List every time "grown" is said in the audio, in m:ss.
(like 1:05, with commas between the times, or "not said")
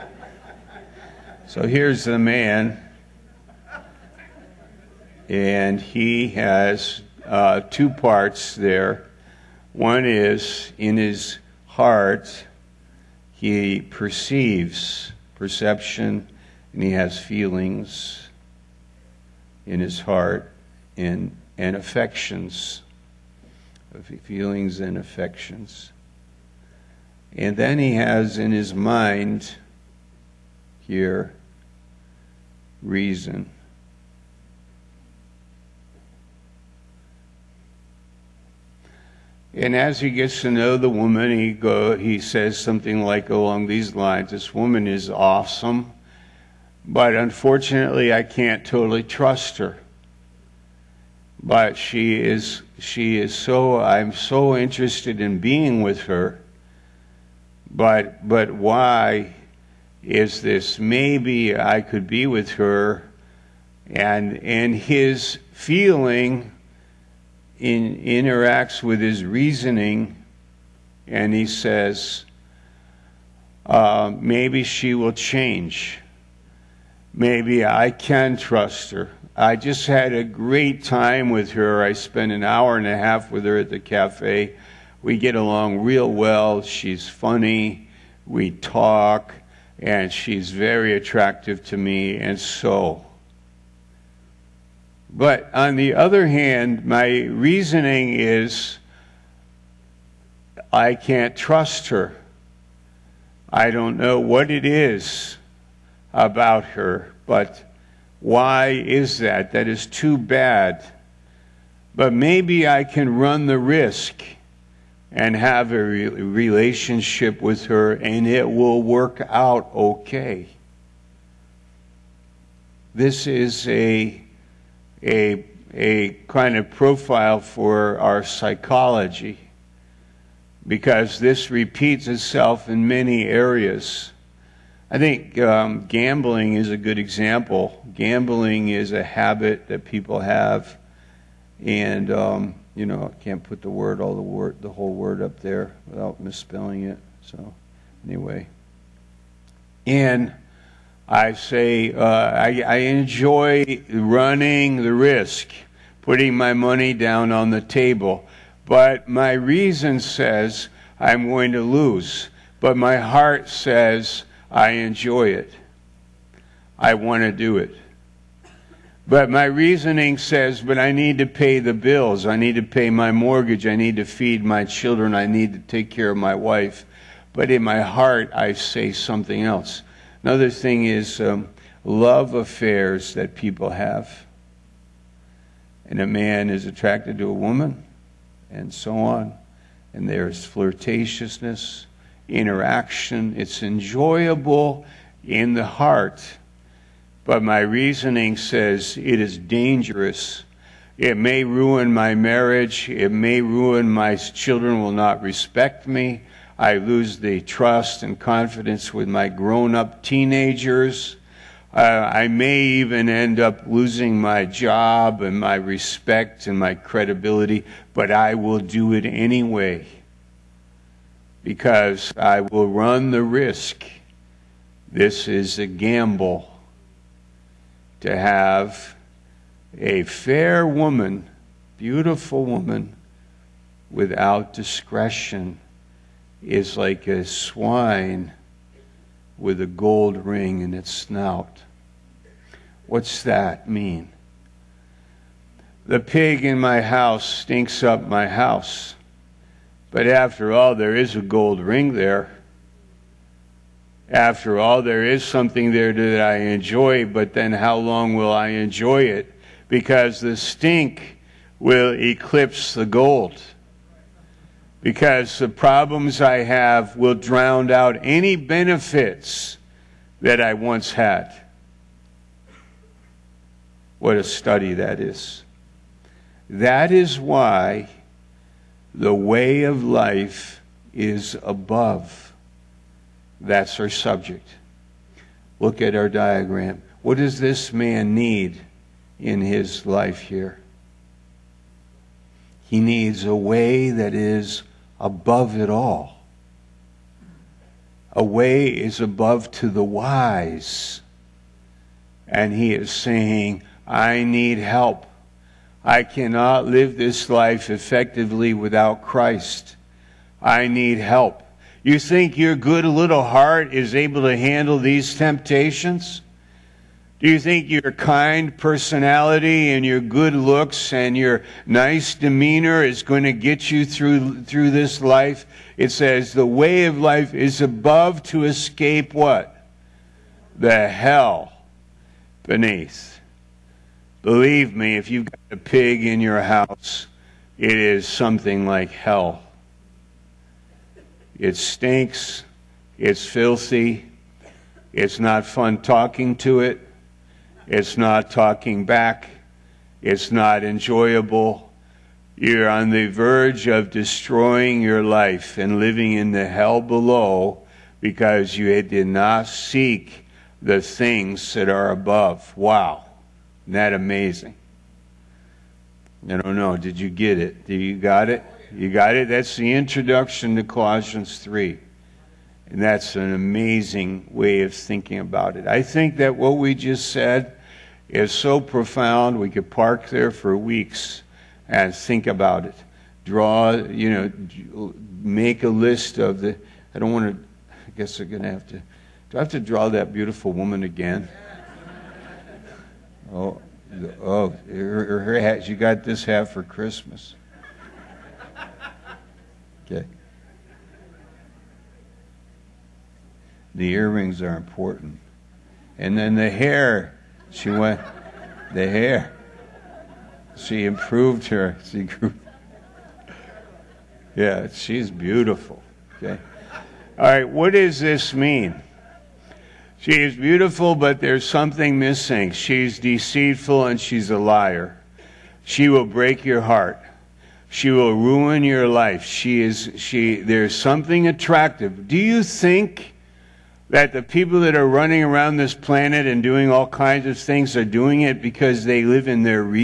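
3:29.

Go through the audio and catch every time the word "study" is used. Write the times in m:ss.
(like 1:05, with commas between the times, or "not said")
4:34.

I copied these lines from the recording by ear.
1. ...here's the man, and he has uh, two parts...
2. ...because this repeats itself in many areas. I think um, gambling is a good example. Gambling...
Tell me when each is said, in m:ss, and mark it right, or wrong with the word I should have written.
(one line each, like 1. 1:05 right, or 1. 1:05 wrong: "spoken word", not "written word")
1. 0:01 right
2. 2:10 right.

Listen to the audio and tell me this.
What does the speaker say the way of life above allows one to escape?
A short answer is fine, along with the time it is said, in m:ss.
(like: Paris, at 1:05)
The hell beneath, at 5:30.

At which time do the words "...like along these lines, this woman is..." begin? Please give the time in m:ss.
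0:43.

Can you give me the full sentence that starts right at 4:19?
Because the stink will eclipse the gold.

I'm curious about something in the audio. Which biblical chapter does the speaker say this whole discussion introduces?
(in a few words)
Colossians 3.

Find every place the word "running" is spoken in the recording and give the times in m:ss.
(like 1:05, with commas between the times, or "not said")
2:33, 7:14.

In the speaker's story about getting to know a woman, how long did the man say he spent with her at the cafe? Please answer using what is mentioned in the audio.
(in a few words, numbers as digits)
an hour and a half.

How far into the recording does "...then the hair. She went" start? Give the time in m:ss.
6:46.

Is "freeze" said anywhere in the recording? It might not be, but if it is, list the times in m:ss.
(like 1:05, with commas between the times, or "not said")
not said.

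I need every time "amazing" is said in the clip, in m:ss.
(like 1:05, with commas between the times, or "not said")
6:03, 6:13.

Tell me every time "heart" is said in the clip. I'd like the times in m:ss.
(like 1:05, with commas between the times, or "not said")
0:11, 0:19, 2:42, 2:57, 3:15, 5:13, 7:06.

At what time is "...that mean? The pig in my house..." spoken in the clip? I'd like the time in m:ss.
4:03.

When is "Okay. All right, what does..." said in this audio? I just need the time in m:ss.
6:56.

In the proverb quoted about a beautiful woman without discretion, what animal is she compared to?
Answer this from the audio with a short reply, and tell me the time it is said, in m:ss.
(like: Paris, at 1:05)
A swine, at 3:57.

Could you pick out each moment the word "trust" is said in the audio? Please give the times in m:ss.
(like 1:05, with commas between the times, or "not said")
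0:49, 1:18, 1:41, 3:27.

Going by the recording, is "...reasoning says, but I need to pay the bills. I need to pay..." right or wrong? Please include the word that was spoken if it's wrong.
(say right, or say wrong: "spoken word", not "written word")
right.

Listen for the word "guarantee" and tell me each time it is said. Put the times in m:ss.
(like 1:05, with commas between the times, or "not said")
not said.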